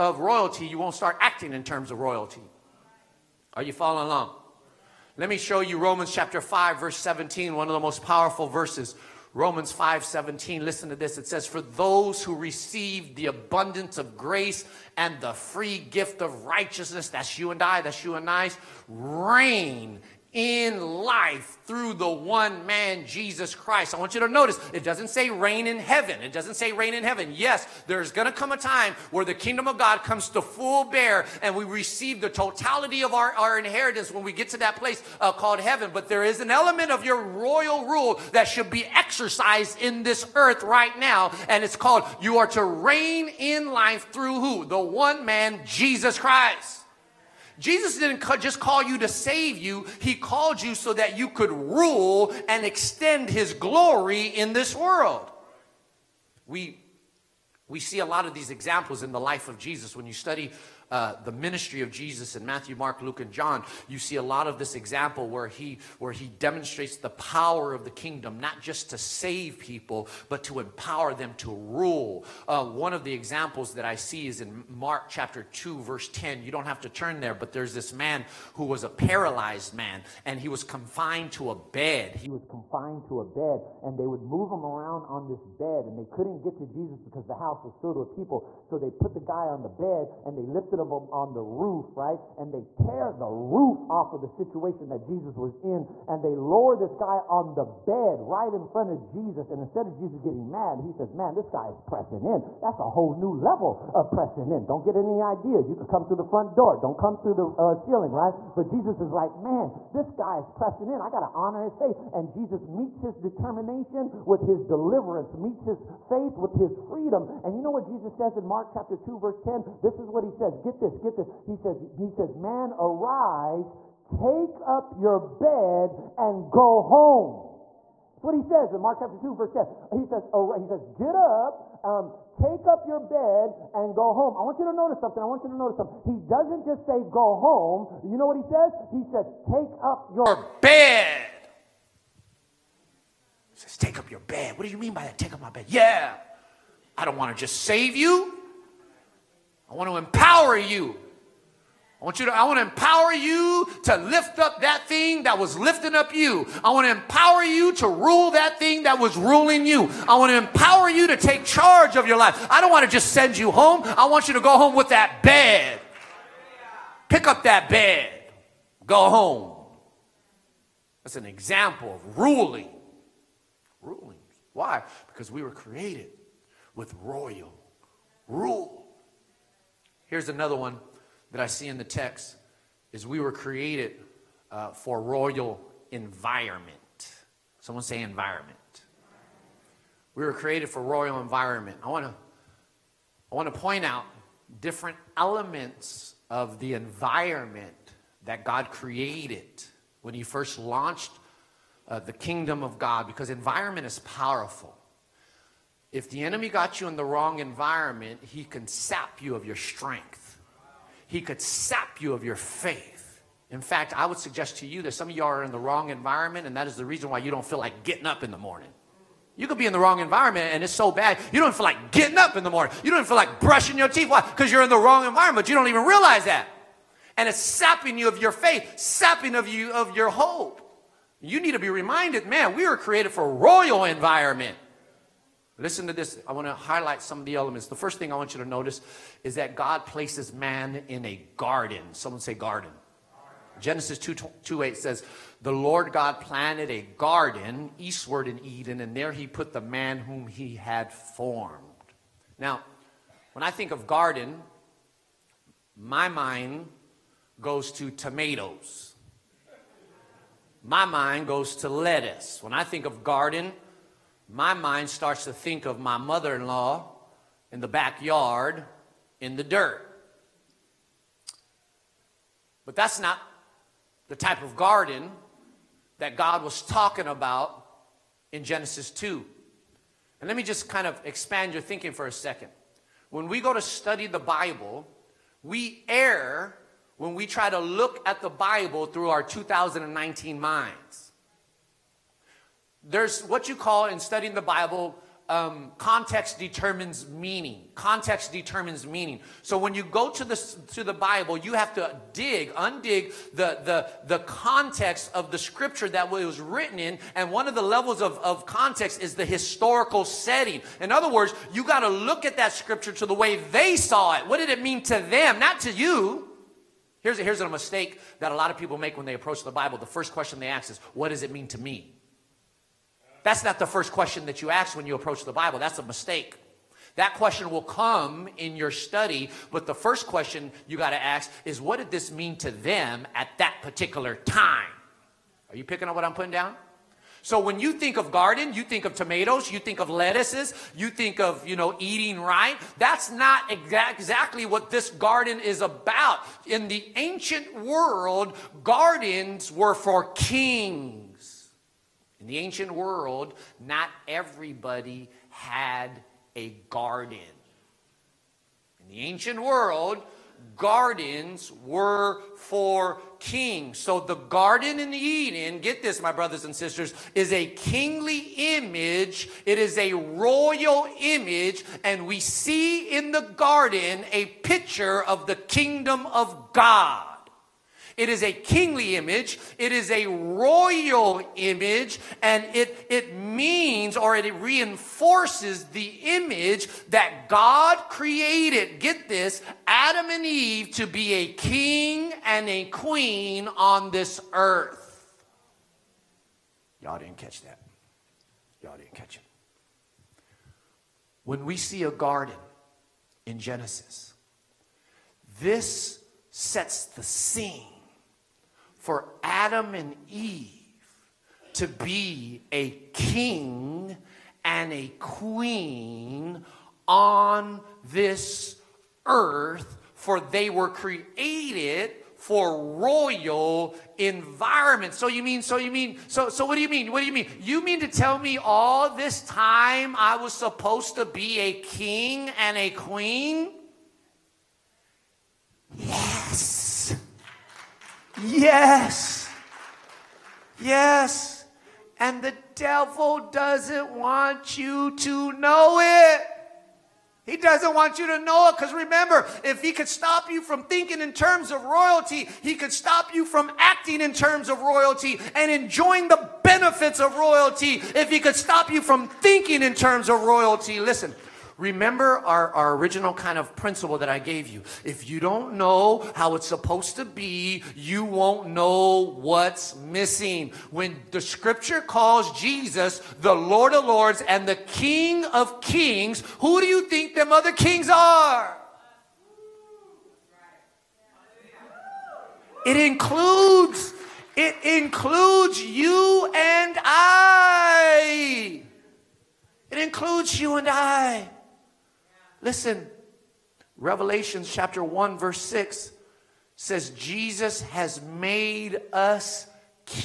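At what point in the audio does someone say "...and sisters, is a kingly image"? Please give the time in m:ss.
6:06.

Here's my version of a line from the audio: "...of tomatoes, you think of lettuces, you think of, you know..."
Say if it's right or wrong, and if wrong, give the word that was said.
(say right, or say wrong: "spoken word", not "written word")
right.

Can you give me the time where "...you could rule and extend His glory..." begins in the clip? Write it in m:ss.
0:51.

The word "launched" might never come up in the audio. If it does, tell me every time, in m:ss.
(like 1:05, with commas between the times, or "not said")
3:20.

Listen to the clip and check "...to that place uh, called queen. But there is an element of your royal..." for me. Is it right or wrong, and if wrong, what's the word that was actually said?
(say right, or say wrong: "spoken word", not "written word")
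wrong: "heaven", not "queen".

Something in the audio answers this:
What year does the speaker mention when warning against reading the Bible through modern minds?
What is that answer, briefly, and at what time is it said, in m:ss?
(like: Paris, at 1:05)
2019, at 4:49.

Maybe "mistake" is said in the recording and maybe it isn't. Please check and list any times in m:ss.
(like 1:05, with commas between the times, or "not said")
5:17, 5:25.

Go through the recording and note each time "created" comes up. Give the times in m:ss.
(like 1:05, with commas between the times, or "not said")
2:55, 3:03, 3:10, 3:18, 3:52, 6:27, 7:00.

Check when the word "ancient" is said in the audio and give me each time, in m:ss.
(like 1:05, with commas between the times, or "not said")
5:46, 5:52, 5:59.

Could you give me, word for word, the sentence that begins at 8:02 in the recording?
It includes, it includes you and I.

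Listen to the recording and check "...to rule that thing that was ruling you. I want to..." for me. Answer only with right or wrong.
right.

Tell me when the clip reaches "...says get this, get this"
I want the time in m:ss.
2:00.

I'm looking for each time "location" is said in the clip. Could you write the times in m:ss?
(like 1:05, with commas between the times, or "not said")
not said.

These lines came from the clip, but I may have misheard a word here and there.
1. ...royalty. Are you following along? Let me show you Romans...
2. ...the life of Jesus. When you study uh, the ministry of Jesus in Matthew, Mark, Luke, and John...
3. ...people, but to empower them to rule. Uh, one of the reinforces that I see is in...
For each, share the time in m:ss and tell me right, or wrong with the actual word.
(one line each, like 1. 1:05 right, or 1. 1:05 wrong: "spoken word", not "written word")
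1. 0:01 right
2. 0:59 right
3. 1:09 wrong: "examples", not "reinforces".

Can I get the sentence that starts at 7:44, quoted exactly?
If you don't know how it's supposed to be, you won't know what's missing.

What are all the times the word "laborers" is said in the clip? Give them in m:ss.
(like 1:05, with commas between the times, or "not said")
not said.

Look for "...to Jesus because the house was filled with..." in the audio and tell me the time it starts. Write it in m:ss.
1:26.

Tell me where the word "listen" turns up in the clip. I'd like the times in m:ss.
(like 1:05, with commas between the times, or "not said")
0:10, 3:55, 7:40, 8:12.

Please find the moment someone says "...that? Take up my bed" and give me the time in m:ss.
2:25.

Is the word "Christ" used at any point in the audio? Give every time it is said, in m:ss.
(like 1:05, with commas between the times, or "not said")
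0:23, 0:46.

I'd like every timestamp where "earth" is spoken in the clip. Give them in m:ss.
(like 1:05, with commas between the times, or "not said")
0:40, 6:34, 6:59.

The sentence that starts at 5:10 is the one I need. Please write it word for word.
In other words, you got to look at that scripture to the way they saw it.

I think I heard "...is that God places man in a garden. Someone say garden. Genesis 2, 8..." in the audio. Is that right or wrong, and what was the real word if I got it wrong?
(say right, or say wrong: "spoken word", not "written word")
wrong: "2", not "8".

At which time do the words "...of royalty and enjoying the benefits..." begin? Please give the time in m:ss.
7:34.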